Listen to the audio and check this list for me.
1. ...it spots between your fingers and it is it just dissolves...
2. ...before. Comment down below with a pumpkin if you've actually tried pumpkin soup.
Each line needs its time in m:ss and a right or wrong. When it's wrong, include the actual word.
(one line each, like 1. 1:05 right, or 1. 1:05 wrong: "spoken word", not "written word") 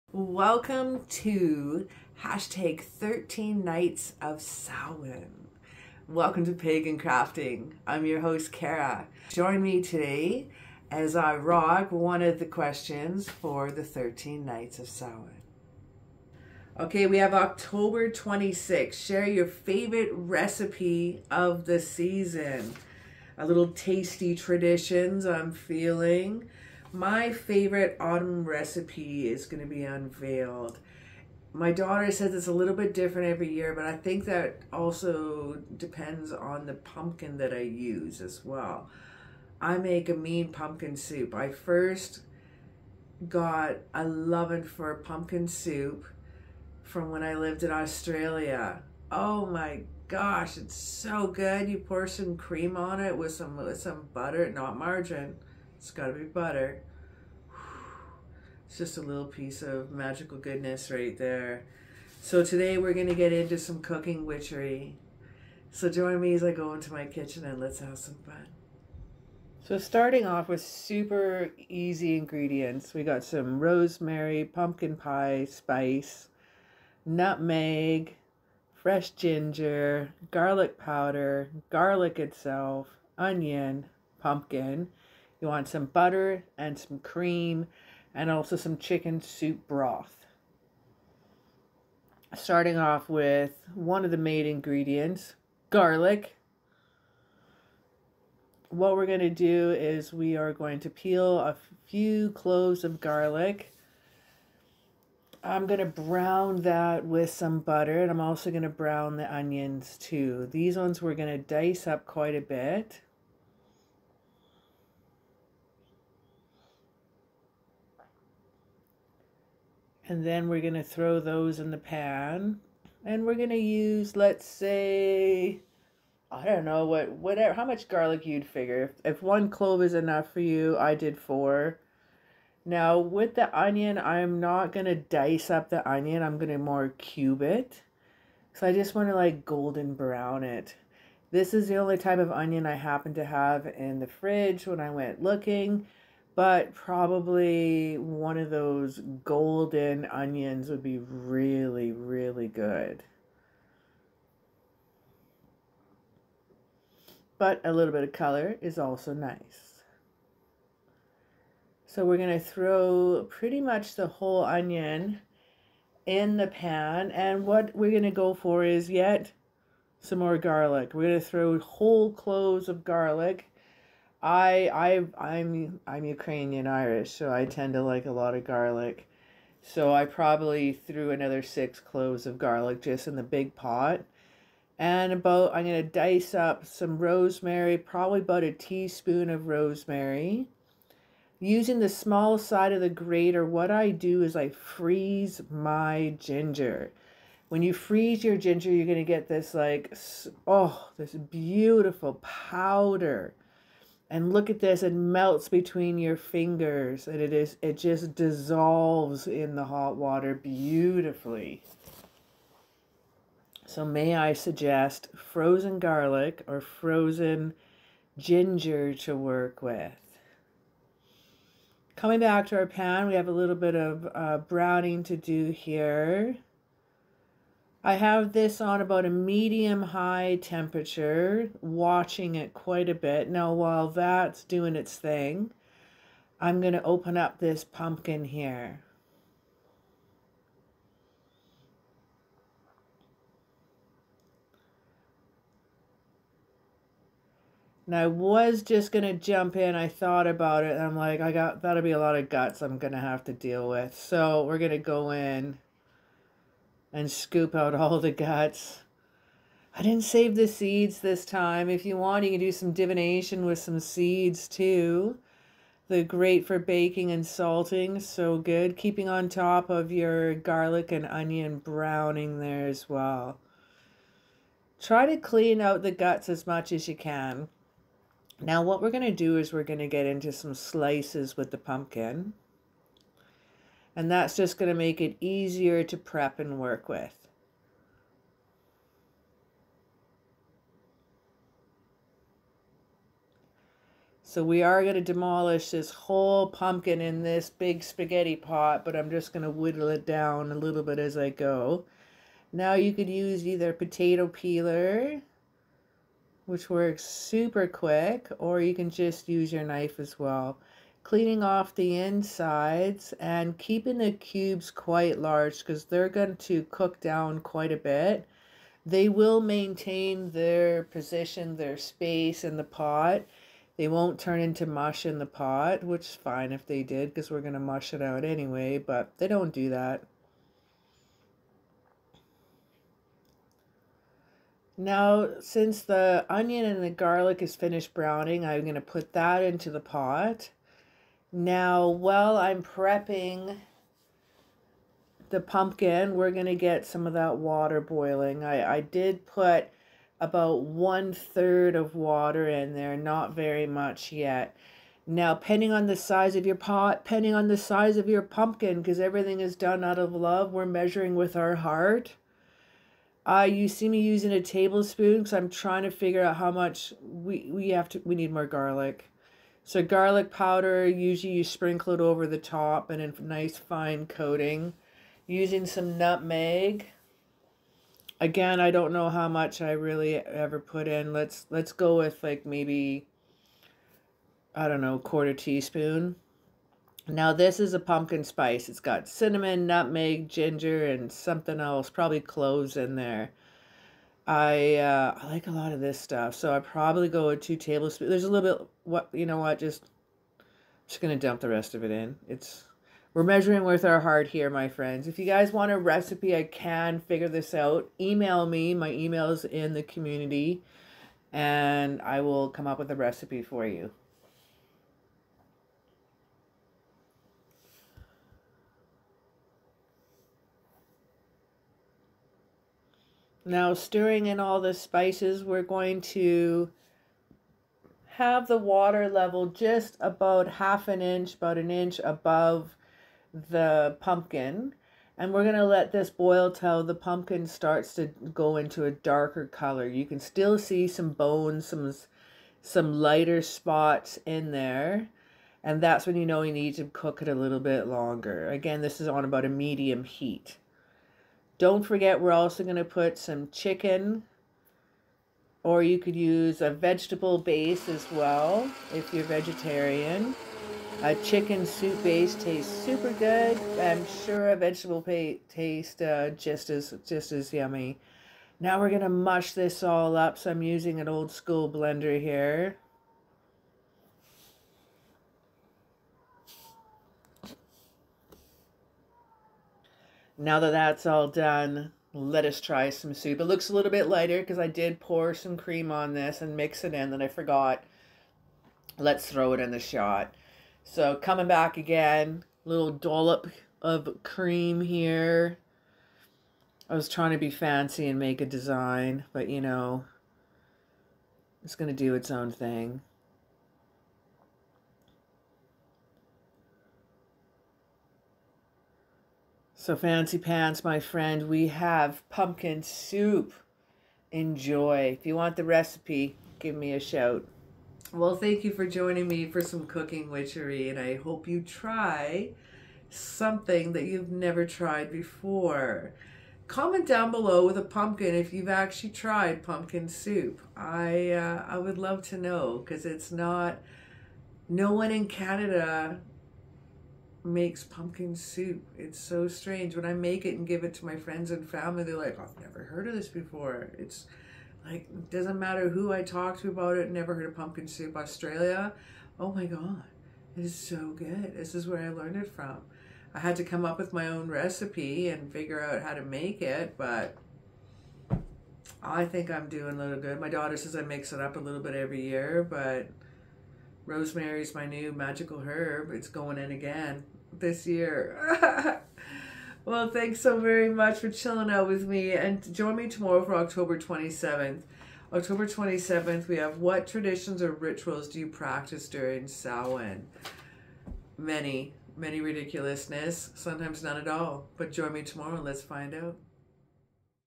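1. 3:24 wrong: "melts", not "spots"
2. 8:45 right.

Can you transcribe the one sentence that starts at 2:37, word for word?
But a little bit of color is also nice.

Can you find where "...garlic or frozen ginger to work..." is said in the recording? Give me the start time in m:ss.
3:35.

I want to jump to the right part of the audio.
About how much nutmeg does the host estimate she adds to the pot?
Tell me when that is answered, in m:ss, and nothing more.
6:24.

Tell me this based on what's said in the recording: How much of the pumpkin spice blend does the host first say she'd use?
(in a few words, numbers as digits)
2 tablespoons.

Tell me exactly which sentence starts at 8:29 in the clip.
So, Fancy Pants, my friend, we have pumpkin soup.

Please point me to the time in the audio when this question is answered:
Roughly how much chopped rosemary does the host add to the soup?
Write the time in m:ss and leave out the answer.
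3:08.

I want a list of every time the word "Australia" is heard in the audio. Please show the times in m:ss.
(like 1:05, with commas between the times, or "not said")
0:47, 9:08.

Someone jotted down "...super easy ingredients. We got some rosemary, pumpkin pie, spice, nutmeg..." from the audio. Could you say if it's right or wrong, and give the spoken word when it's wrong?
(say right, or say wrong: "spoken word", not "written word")
right.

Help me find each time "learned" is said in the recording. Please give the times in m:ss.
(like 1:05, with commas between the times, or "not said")
9:12.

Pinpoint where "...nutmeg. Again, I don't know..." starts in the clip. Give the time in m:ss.
6:15.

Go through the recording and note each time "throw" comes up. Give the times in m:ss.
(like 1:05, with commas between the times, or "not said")
2:00, 2:42, 2:51, 8:09.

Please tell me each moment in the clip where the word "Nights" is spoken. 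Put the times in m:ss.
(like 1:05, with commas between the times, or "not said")
0:03, 0:14.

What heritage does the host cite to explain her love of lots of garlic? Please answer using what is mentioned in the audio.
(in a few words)
Ukrainian Irish.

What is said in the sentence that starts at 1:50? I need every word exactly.
These ones we're going to dice up quite a bit.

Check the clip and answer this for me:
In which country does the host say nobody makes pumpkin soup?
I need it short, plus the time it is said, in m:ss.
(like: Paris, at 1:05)
Canada, at 8:55.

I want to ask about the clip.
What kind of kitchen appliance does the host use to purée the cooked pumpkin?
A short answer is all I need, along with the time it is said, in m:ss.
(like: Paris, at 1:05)
Old school blender, at 7:51.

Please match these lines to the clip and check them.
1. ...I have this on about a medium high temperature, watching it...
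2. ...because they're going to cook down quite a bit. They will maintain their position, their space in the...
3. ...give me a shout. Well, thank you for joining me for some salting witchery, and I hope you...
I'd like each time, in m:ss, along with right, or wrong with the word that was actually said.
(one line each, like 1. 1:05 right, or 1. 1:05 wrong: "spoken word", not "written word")
1. 3:47 right
2. 5:15 right
3. 8:36 wrong: "cooking", not "salting".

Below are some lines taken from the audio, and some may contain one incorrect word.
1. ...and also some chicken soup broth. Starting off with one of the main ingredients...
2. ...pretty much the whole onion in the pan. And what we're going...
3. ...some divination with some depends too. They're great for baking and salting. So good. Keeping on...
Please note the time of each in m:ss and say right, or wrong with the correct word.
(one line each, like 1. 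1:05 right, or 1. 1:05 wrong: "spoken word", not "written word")
1. 1:28 right
2. 2:43 right
3. 4:22 wrong: "seeds", not "depends".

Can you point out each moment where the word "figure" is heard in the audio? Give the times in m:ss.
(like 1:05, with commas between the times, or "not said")
2:08, 6:05, 6:46, 9:15.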